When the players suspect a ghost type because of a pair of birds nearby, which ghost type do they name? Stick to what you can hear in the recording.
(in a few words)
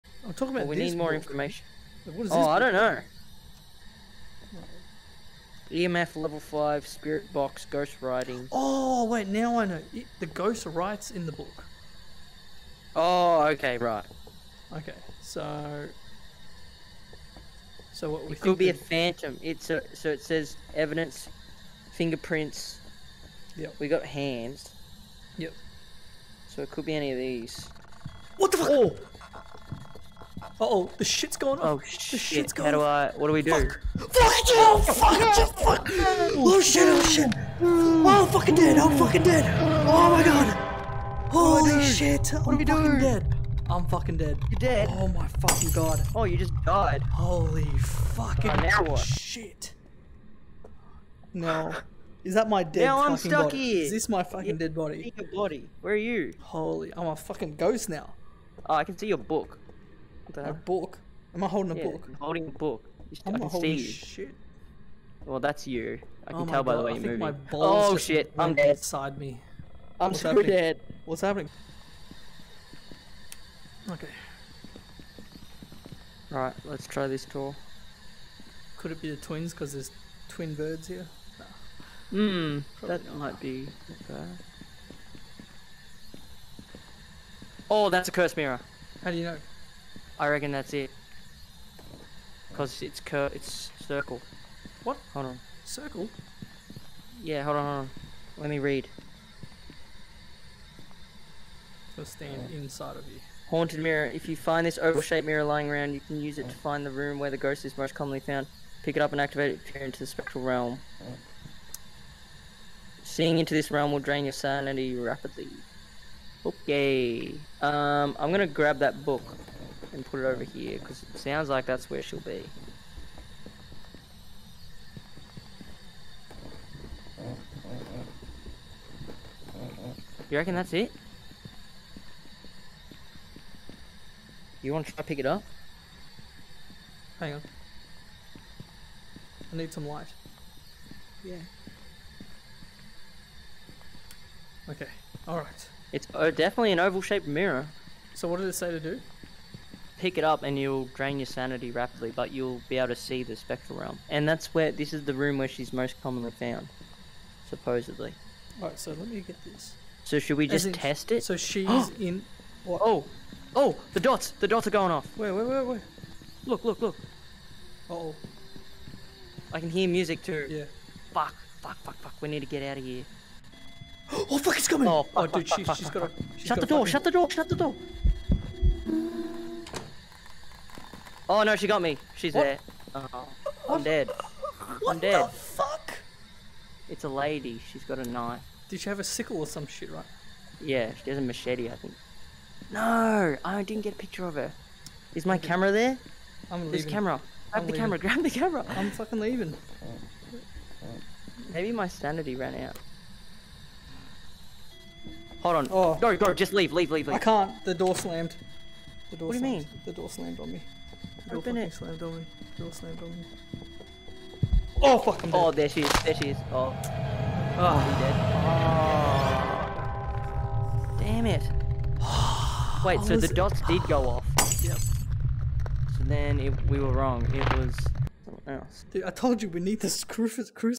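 The twins.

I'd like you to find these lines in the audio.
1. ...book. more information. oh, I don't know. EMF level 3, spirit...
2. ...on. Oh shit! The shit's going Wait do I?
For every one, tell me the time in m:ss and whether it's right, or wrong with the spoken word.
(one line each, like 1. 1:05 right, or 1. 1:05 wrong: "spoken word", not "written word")
1. 0:00 wrong: "5", not "3"
2. 0:31 wrong: "How", not "Wait".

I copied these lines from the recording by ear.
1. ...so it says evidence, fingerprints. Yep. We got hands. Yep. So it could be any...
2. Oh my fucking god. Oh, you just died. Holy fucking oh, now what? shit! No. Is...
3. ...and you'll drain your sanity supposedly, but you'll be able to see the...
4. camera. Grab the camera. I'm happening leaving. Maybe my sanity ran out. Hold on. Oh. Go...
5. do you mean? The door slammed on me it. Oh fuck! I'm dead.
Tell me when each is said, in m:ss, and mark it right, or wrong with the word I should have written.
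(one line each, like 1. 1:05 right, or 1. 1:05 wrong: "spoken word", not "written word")
1. 0:19 right
2. 0:44 right
3. 2:30 wrong: "rapidly", not "supposedly"
4. 3:17 wrong: "fucking", not "happening"
5. 3:29 right.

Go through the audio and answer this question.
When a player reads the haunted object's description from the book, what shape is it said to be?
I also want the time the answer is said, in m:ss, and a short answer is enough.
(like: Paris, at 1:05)
Oval-shaped, at 1:44.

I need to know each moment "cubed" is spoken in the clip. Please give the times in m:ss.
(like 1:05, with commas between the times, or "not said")
not said.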